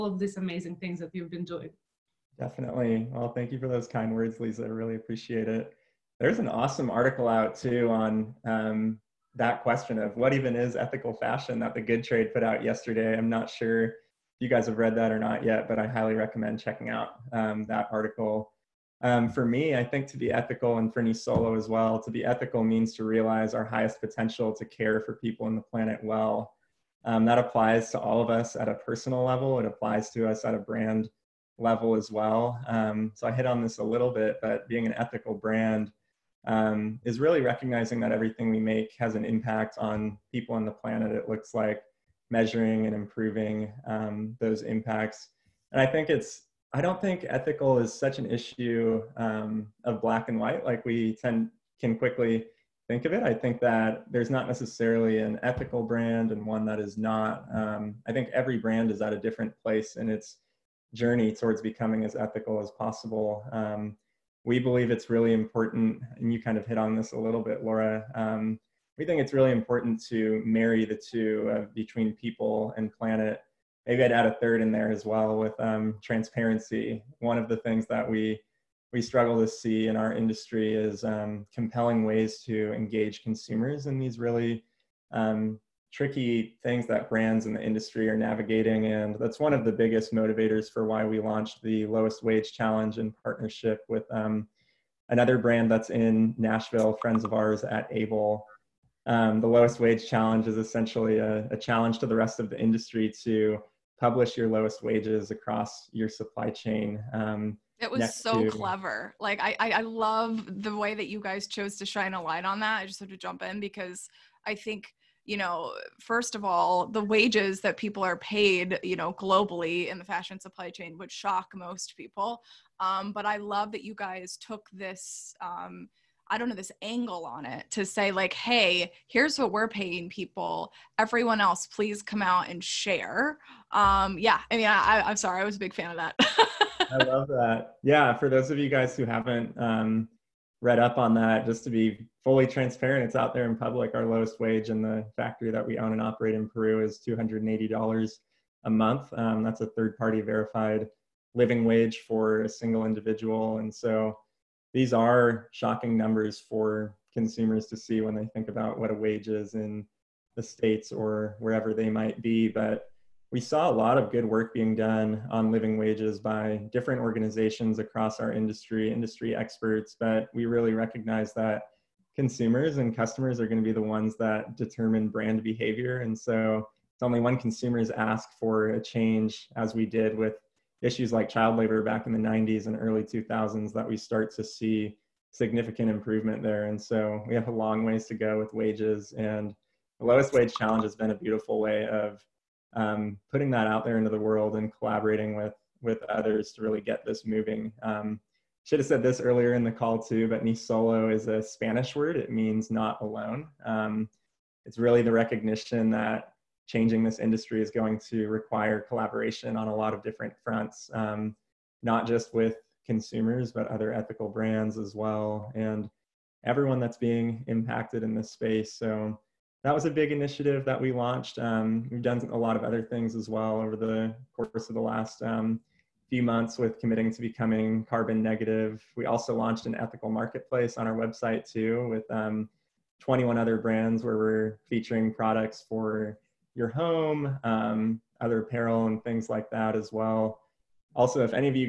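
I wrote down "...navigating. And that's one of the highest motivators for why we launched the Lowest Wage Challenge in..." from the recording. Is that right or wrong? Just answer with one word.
wrong.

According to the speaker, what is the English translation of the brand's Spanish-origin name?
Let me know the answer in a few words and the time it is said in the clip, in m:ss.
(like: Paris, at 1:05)
not alone, at 3:22.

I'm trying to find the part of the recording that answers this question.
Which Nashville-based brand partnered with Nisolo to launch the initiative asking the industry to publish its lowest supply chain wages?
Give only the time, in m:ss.
1:37.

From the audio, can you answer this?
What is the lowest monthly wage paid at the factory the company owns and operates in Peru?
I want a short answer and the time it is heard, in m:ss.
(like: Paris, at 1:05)
$280, at 2:27.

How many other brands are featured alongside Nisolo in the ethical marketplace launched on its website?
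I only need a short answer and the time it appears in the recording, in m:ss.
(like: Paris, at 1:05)
21, at 3:53.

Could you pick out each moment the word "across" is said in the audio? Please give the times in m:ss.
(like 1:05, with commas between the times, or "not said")
1:45, 2:47.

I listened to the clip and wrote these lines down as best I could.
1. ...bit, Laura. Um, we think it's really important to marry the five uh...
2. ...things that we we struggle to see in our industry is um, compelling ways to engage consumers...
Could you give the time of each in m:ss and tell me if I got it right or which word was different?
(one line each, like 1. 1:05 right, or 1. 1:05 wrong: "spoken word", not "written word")
1. 1:07 wrong: "two", not "five"
2. 1:17 right.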